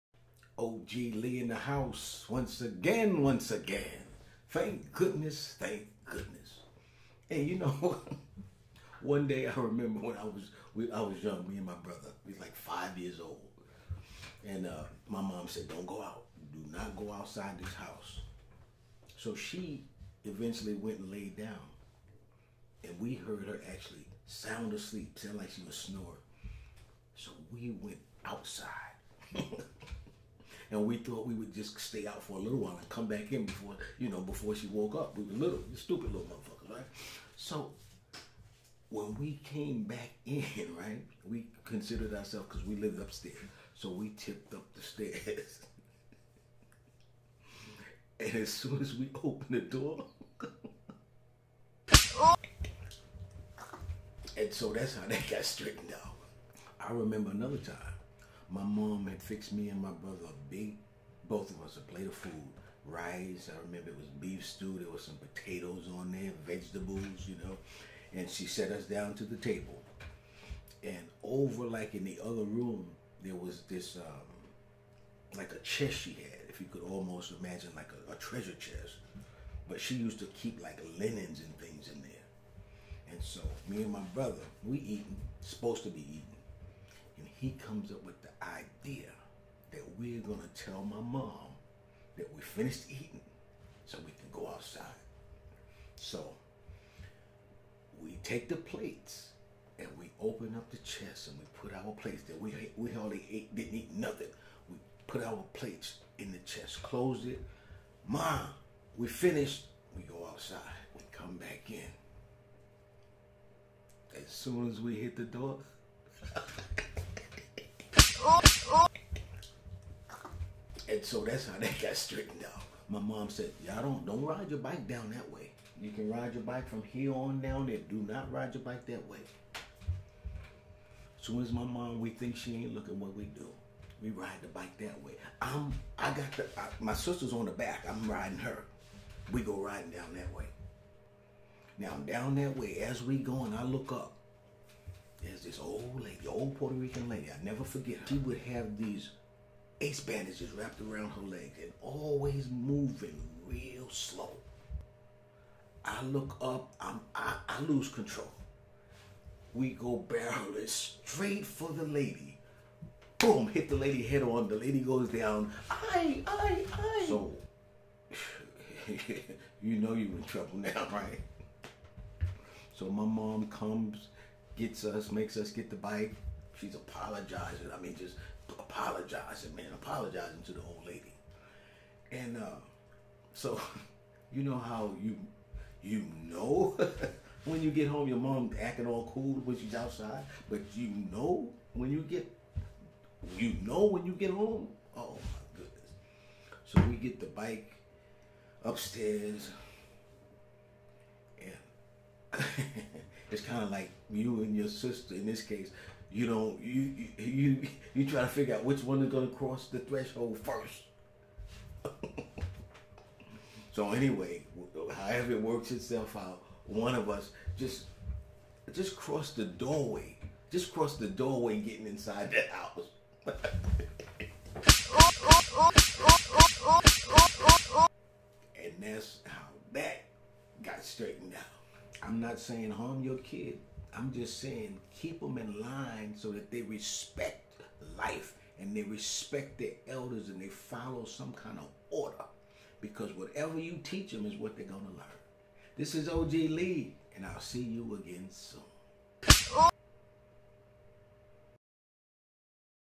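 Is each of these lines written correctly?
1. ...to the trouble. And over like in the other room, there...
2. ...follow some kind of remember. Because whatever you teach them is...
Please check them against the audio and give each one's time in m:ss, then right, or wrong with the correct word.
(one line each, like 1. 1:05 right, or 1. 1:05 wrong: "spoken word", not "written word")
1. 1:09 wrong: "table", not "trouble"
2. 4:00 wrong: "order", not "remember".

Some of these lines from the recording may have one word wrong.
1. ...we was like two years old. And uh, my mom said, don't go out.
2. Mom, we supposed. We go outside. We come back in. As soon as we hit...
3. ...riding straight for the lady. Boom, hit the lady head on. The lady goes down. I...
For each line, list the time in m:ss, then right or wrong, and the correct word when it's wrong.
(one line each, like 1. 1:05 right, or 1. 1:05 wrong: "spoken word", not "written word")
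1. 0:12 wrong: "five", not "two"
2. 1:48 wrong: "finished", not "supposed"
3. 2:40 wrong: "barreling", not "riding".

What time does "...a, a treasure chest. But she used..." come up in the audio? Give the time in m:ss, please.
1:18.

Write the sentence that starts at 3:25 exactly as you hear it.
In this case, you know, you you you, you try to figure out which one is going to cross the threshold first.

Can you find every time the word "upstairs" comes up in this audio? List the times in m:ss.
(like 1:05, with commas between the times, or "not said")
0:43, 3:18.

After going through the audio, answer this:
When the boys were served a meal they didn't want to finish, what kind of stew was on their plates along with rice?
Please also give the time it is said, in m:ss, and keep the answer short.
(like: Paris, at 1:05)
beef stew, at 1:04.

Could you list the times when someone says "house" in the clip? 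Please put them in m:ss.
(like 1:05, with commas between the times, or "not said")
0:01, 0:17, 3:42.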